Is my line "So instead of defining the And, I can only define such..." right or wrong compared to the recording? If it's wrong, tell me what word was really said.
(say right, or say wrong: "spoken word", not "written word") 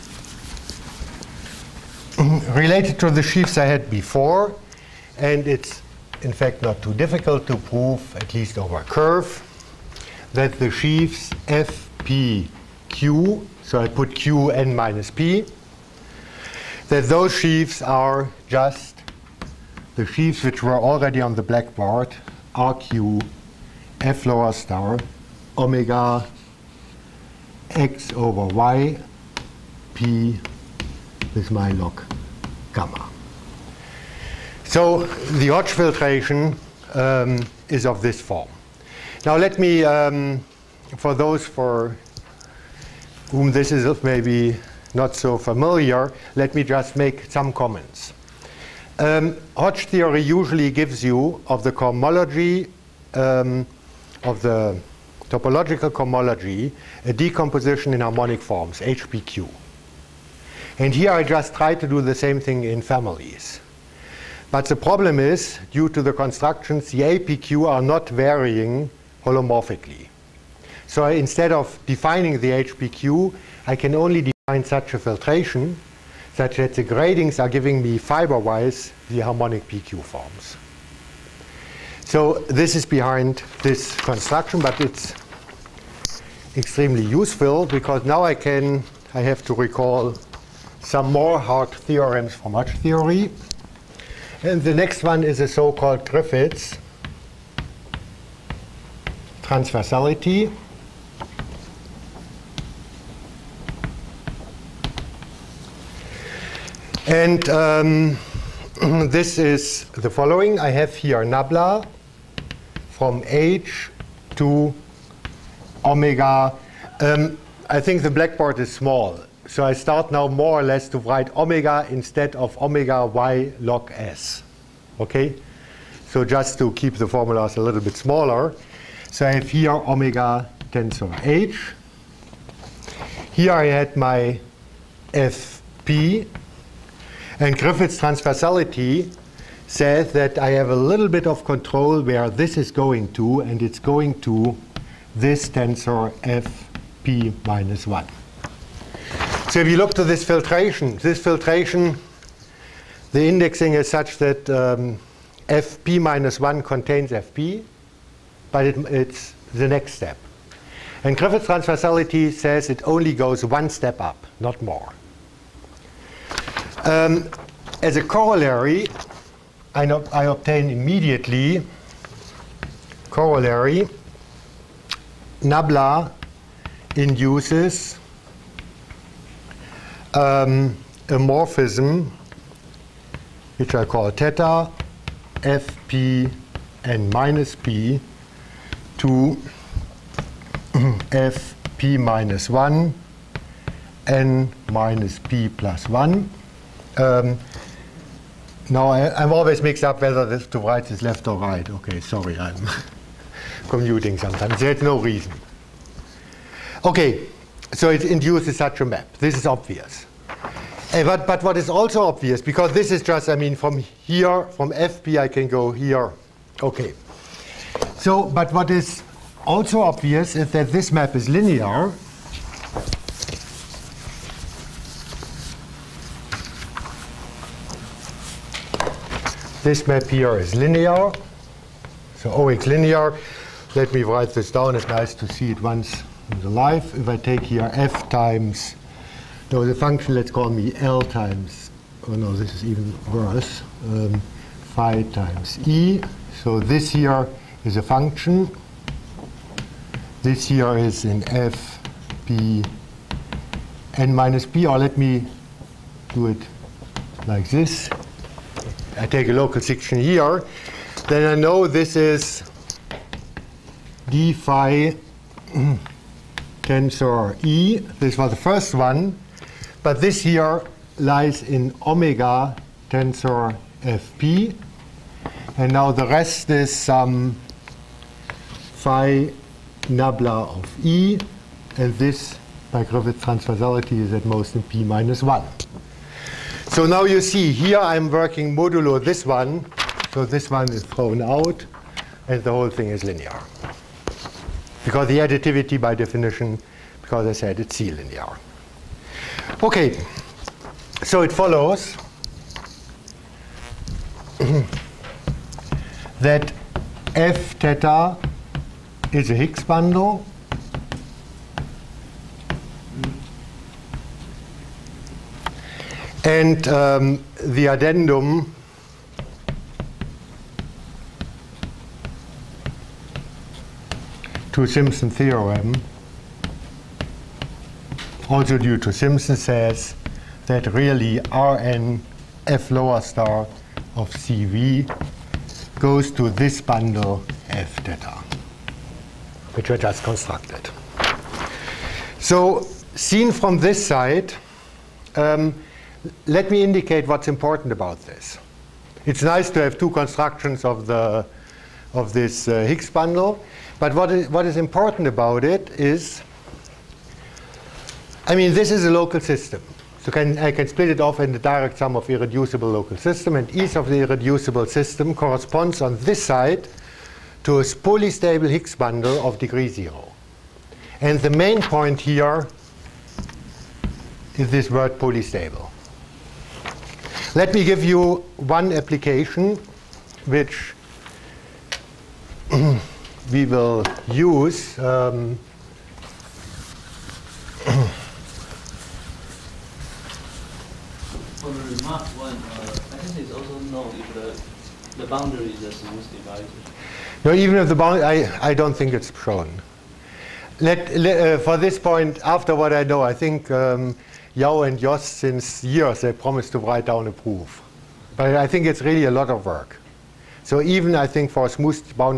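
wrong: "HPQ", not "And".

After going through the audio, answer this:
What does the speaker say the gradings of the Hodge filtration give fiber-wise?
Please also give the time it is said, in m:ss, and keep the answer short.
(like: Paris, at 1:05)
Harmonic PQ forms, at 1:19.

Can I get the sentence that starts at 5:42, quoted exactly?
So, seen from this side, um, let me indicate what's important about this.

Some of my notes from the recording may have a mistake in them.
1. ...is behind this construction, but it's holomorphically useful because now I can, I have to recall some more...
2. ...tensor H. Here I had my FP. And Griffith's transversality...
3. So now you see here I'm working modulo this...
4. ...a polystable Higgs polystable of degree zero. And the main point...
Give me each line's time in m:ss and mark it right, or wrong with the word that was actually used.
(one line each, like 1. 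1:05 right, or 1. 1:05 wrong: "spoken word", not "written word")
1. 1:22 wrong: "extremely", not "holomorphically"
2. 2:10 right
3. 4:46 right
4. 6:07 wrong: "bundle", not "polystable".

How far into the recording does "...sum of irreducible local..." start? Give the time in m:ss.
6:01.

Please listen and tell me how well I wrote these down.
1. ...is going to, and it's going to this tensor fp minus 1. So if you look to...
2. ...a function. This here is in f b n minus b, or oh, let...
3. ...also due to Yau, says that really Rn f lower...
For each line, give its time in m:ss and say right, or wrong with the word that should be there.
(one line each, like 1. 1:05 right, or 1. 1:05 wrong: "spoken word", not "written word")
1. 2:22 right
2. 4:07 right
3. 5:28 wrong: "Simpson", not "Yau".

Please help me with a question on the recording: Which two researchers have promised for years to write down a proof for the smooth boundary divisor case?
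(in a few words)
Yau and Jost.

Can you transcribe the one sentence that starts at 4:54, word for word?
Because the additivity by definition, because I said it's C linear.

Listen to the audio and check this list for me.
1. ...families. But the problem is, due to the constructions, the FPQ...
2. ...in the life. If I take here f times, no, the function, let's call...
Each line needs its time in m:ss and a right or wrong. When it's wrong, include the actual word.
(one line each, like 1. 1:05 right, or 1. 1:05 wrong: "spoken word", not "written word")
1. 1:02 wrong: "APQ", not "FPQ"
2. 3:56 right.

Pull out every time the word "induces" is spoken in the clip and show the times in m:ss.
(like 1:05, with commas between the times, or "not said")
2:56, 3:28.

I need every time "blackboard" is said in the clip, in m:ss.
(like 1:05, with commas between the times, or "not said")
0:21, 1:58.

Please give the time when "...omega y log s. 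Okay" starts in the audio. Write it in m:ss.
2:02.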